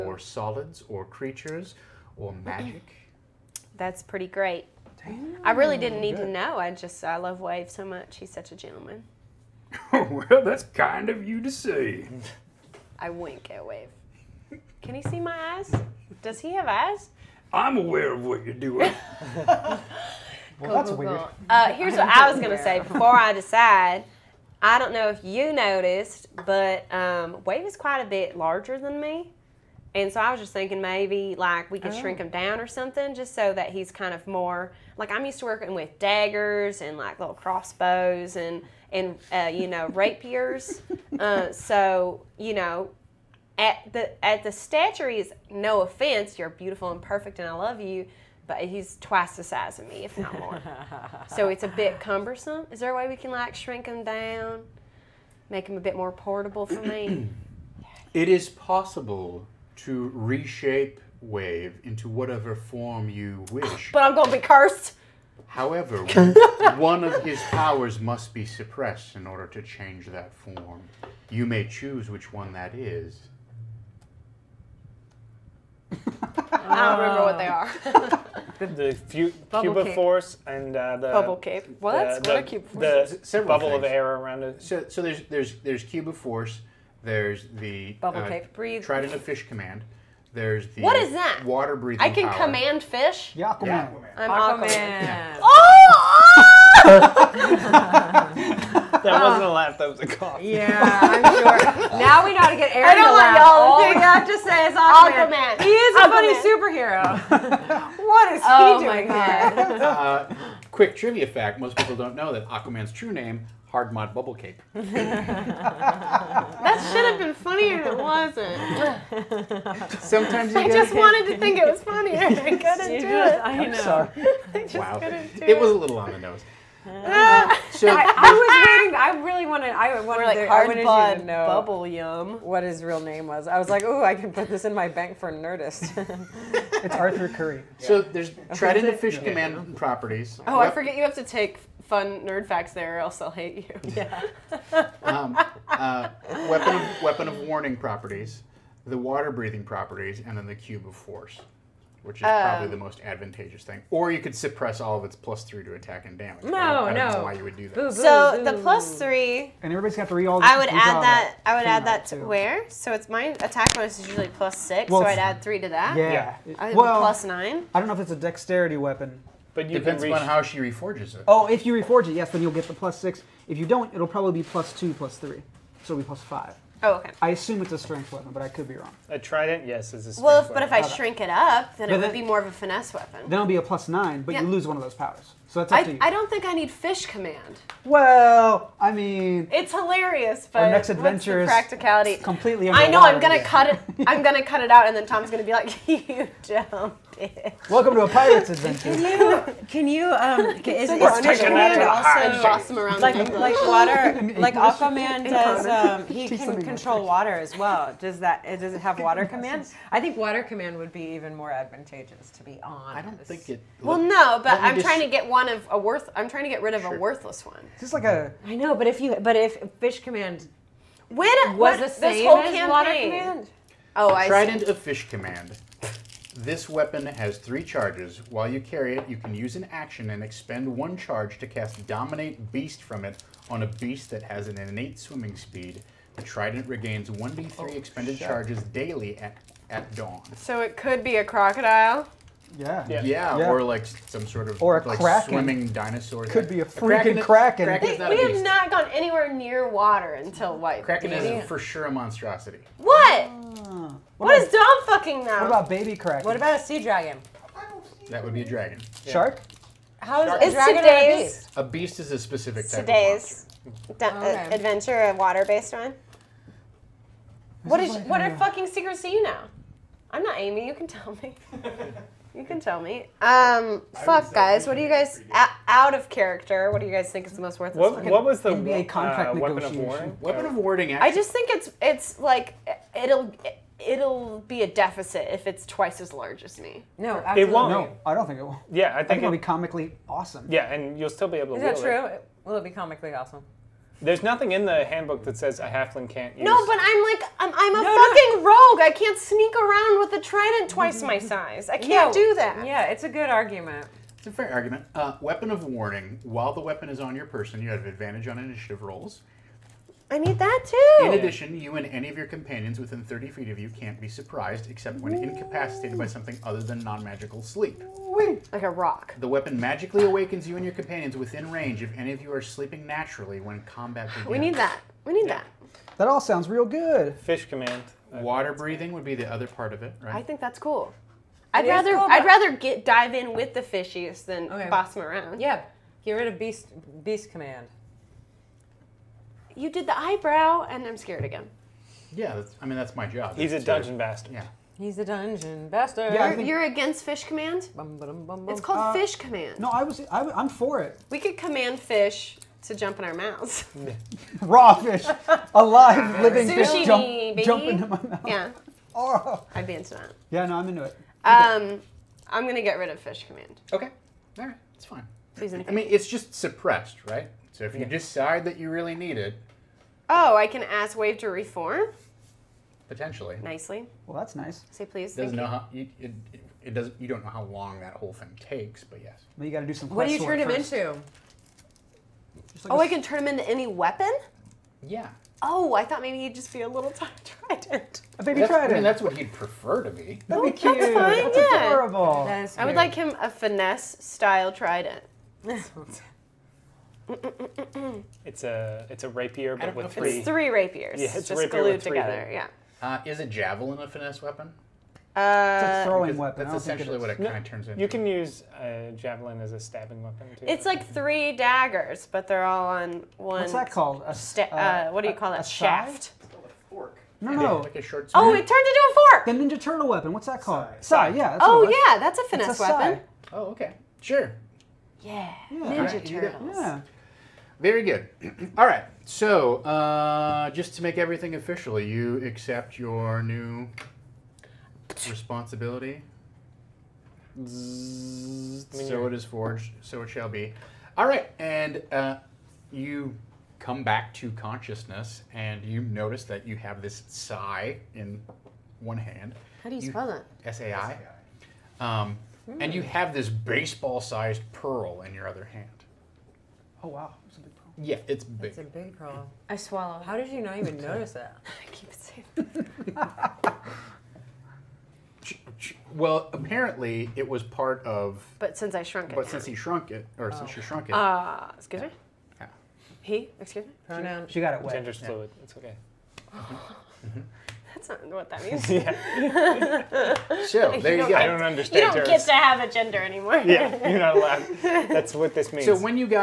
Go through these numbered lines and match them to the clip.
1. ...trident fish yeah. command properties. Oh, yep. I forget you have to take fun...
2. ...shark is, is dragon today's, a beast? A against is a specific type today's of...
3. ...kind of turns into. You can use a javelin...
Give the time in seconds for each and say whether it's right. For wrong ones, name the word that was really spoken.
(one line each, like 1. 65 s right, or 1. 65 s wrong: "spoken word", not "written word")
1. 138 s right
2. 260 s wrong: "beast", not "against"
3. 407 s right.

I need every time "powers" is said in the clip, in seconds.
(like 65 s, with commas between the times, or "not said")
67 s, 92 s, 184 s.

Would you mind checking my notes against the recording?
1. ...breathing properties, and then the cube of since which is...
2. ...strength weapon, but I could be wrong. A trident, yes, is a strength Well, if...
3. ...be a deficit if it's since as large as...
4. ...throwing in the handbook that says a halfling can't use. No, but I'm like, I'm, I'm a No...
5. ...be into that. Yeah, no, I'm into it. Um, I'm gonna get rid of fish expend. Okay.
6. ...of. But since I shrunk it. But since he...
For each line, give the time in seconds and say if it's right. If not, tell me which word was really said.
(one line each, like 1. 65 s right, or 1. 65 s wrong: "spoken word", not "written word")
1. 149 s wrong: "force", not "since"
2. 177 s right
3. 284 s wrong: "twice", not "since"
4. 294 s wrong: "nothing", not "throwing"
5. 359 s wrong: "command", not "expend"
6. 467 s right.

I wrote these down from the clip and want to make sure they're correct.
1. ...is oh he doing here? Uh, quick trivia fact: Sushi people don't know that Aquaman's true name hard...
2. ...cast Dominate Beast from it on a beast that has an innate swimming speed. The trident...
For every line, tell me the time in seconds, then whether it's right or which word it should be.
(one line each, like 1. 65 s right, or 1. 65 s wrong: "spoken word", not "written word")
1. 108 s wrong: "Most", not "Sushi"
2. 231 s right.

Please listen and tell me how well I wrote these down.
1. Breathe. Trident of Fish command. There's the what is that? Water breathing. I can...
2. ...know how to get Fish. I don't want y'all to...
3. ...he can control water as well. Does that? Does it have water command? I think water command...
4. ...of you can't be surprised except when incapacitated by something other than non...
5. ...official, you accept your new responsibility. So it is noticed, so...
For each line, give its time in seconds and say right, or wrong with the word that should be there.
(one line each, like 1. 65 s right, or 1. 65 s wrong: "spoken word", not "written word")
1. 88 s right
2. 102 s wrong: "Aaron", not "Fish"
3. 206 s right
4. 313 s right
5. 431 s wrong: "forged", not "noticed".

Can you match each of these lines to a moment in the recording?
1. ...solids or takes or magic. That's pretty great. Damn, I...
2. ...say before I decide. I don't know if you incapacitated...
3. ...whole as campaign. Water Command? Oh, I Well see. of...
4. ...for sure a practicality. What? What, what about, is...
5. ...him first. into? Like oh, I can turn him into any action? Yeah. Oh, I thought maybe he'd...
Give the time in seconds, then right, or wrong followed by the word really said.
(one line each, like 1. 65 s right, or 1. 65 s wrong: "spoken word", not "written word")
1. 0 s wrong: "creatures", not "takes"
2. 22 s wrong: "noticed", not "incapacitated"
3. 222 s wrong: "Trident", not "Well"
4. 251 s wrong: "monstrosity", not "practicality"
5. 380 s wrong: "weapon", not "action".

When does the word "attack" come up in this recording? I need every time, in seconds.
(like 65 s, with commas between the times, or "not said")
155 s, 163 s.